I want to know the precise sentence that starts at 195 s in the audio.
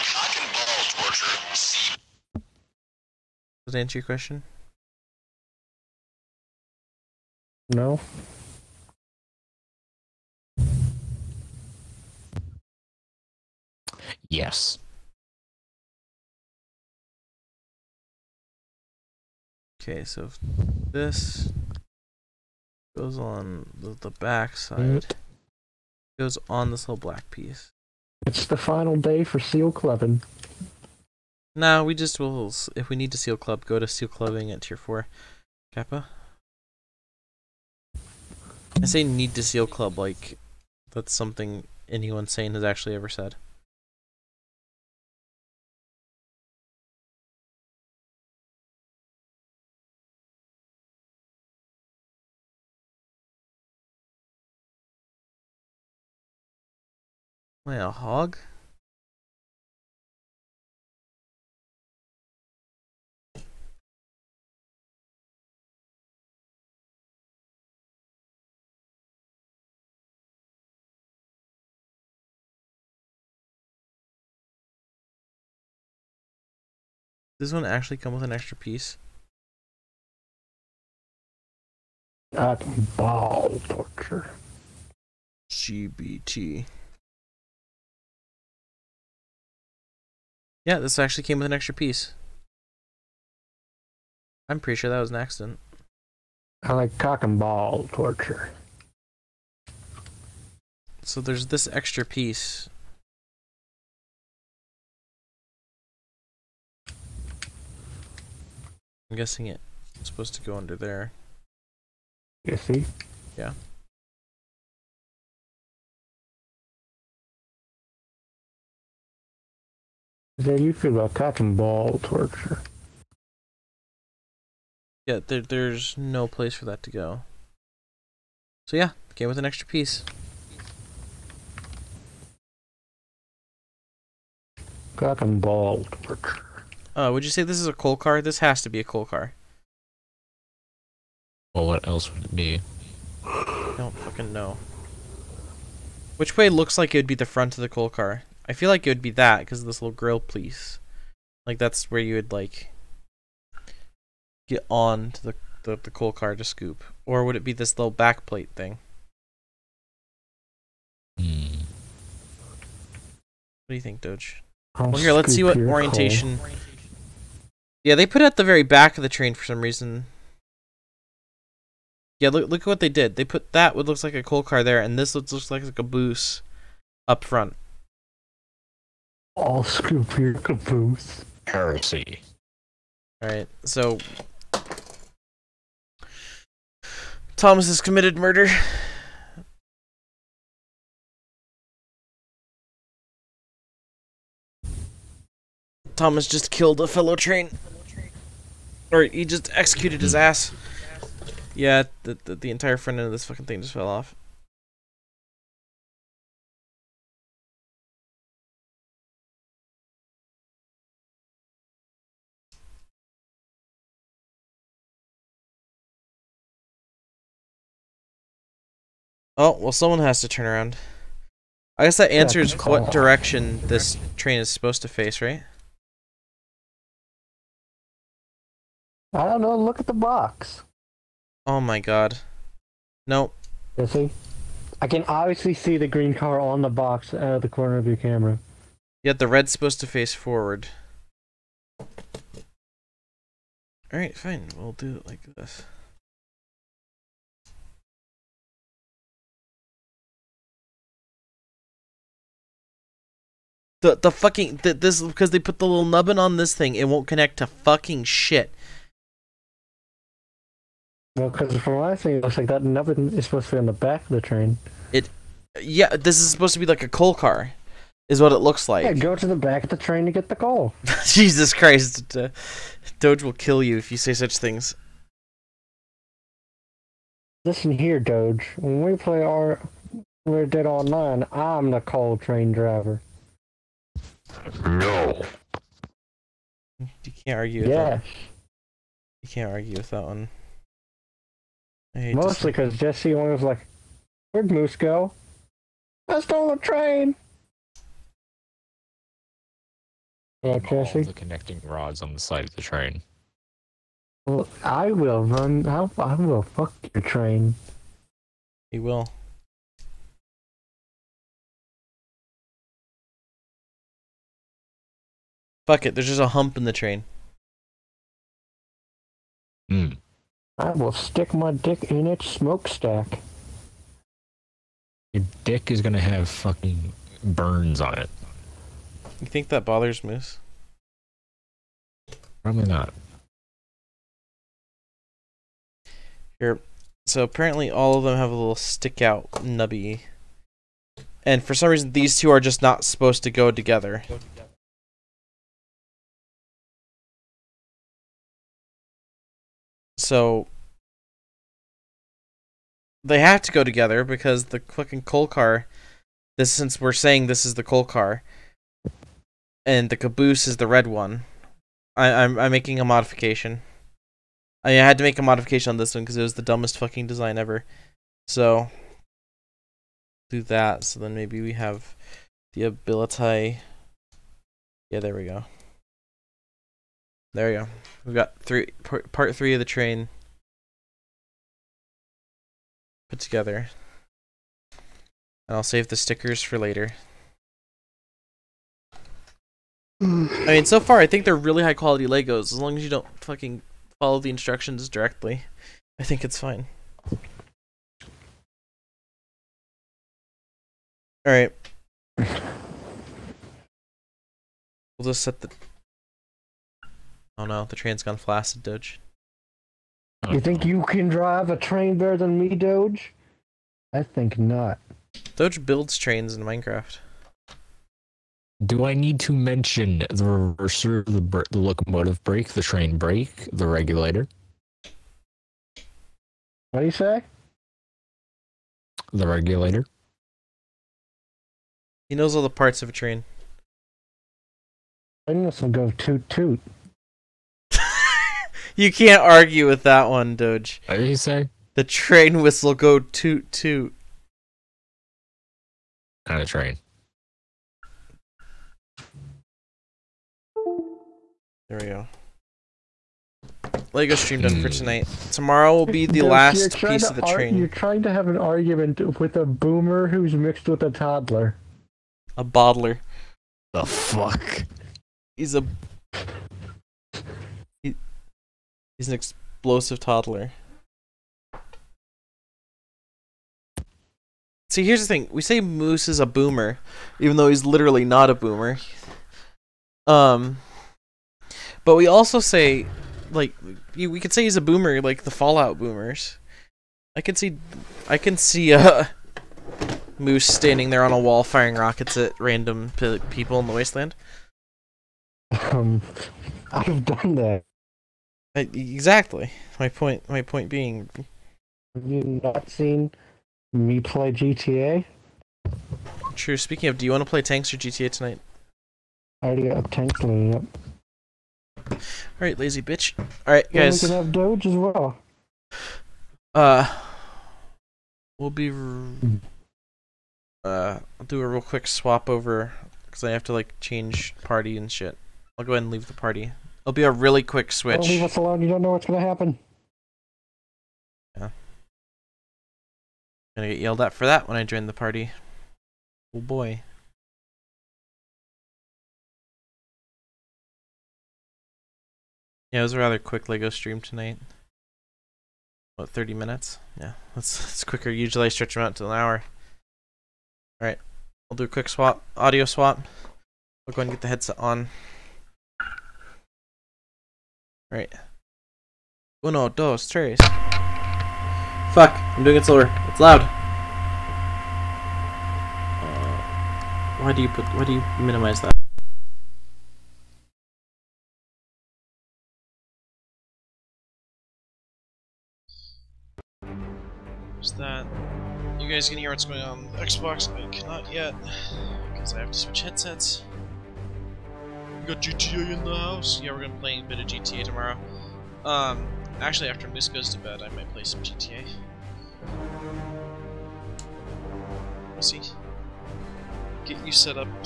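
Thomas just killed a fellow train.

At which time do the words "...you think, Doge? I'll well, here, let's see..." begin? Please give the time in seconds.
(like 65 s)
163 s.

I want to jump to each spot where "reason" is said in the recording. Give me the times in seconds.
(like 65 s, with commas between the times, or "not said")
169 s, 341 s.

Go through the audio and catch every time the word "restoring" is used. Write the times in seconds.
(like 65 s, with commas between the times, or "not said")
not said.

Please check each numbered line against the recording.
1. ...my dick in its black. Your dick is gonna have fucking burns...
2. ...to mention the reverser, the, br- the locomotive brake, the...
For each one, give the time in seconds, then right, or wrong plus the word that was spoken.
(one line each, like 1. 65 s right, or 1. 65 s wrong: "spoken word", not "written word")
1. 321 s wrong: "smokestack", not "black"
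2. 419 s right.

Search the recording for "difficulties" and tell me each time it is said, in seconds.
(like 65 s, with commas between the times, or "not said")
not said.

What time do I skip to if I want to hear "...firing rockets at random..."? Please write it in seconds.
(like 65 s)
491 s.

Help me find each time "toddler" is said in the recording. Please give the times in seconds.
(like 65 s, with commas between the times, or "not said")
460 s, 469 s.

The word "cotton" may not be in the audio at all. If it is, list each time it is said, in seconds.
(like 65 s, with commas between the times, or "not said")
121 s, 134 s.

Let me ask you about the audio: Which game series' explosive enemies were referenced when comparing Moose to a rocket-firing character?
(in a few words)
Fallout.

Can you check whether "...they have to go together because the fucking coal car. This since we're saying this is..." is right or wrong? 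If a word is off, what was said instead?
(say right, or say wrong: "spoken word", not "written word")
right.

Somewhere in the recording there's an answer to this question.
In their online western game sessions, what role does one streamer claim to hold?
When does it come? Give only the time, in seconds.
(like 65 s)
281 s.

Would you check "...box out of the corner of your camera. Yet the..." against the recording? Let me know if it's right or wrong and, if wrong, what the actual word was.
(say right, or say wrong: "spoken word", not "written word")
right.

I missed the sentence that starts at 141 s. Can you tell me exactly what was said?
Well, what else would it be?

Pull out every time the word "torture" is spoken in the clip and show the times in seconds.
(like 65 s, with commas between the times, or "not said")
83 s, 97 s, 122 s, 136 s.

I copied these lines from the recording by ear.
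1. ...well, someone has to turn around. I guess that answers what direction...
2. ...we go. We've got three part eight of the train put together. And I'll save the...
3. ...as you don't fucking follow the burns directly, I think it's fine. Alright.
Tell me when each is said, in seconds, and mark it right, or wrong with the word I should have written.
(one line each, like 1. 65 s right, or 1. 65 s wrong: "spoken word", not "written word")
1. 219 s right
2. 377 s wrong: "three", not "eight"
3. 392 s wrong: "instructions", not "burns".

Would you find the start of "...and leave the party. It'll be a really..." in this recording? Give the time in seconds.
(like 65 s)
525 s.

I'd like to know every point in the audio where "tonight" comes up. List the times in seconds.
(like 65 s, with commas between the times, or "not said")
454 s, 508 s, 544 s.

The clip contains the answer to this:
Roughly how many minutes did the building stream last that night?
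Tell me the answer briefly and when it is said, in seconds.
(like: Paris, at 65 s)
30, at 546 s.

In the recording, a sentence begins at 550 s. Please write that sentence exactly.
Alright, I'll do a quick swap, audio swap.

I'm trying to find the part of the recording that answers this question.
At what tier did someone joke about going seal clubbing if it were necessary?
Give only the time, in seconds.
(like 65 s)
34 s.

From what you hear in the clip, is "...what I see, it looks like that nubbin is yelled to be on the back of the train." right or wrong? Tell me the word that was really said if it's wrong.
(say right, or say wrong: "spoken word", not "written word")
wrong: "supposed", not "yelled".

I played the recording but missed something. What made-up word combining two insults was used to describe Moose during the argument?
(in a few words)
Boddler.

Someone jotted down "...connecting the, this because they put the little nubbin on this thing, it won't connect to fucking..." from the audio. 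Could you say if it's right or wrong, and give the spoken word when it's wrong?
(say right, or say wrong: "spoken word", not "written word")
wrong: "fucking", not "connecting".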